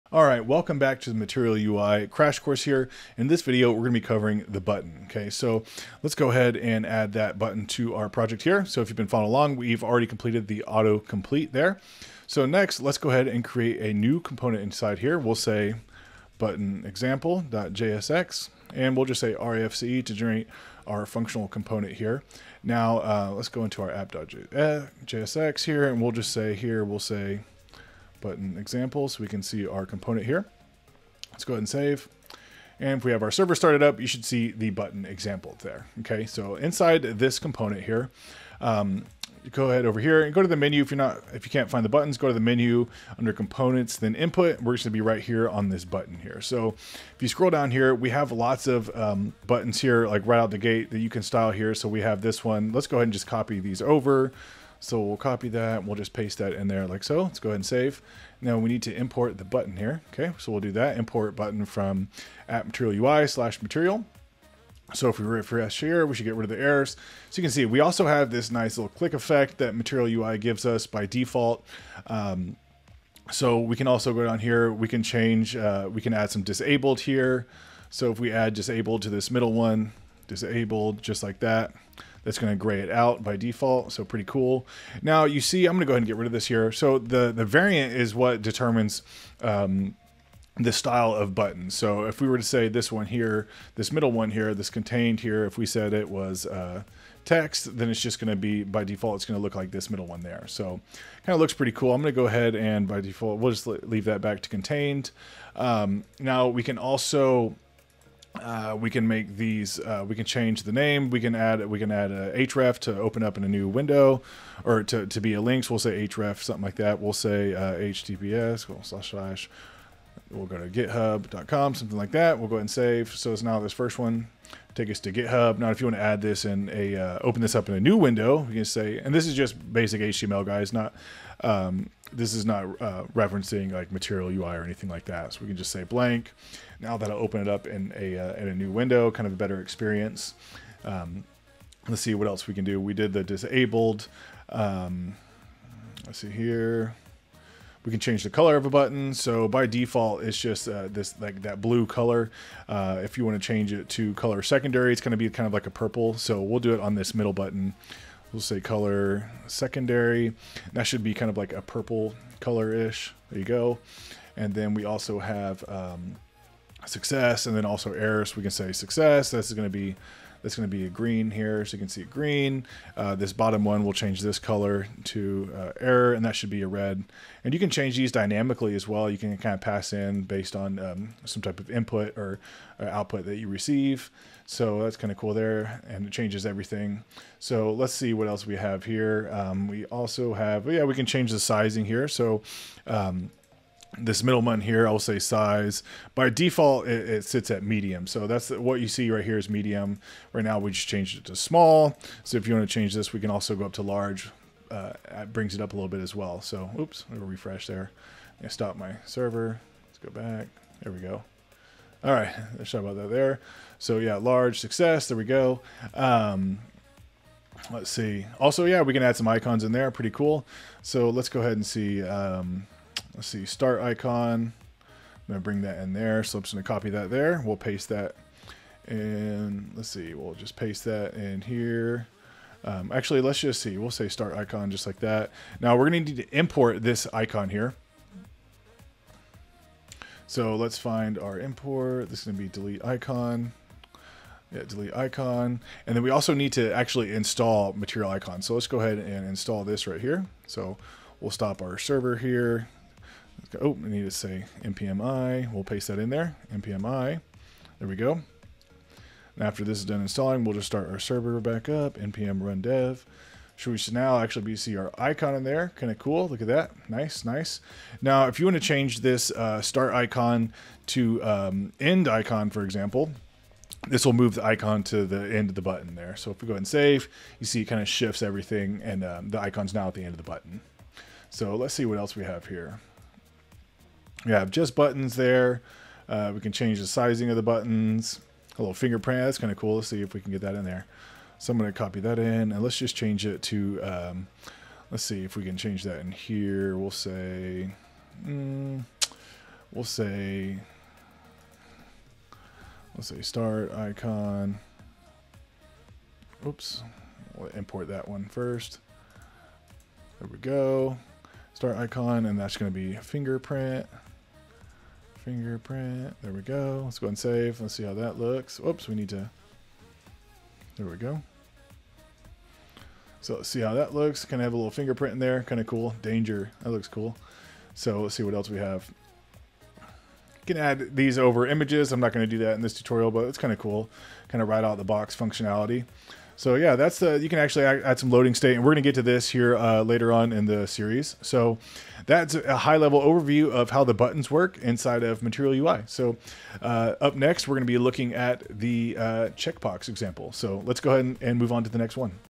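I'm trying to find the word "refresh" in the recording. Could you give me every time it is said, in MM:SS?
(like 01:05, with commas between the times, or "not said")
01:05, 03:27.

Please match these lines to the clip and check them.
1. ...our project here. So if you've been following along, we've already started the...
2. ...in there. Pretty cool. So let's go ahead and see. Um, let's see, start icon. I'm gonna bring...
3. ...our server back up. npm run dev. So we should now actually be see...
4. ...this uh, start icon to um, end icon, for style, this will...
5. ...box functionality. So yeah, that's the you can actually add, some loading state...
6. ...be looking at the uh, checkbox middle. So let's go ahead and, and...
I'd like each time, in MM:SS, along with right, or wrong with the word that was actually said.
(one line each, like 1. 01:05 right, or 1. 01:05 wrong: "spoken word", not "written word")
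1. 00:07 wrong: "completed", not "started"
2. 03:39 right
3. 04:20 right
4. 04:29 wrong: "example", not "style"
5. 05:34 right
6. 05:47 wrong: "example", not "middle".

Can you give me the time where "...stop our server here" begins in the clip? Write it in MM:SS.
04:11.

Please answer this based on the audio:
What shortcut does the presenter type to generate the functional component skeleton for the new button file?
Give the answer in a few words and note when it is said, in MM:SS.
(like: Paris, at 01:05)
RFCE, at 00:19.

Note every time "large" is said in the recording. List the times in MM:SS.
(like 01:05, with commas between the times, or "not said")
03:23, 03:34.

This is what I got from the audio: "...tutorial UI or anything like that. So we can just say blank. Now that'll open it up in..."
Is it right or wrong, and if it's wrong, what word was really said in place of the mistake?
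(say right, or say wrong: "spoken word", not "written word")
wrong: "material", not "tutorial".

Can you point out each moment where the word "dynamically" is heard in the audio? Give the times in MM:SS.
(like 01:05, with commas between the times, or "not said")
02:58.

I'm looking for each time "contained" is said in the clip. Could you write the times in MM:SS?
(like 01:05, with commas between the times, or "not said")
01:34, 01:44.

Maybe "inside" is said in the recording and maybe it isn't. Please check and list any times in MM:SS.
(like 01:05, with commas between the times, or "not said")
00:14, 00:36, 05:44.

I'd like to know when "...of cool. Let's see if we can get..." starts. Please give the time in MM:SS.
04:49.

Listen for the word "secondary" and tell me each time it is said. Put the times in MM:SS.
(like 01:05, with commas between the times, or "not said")
02:34, 02:39.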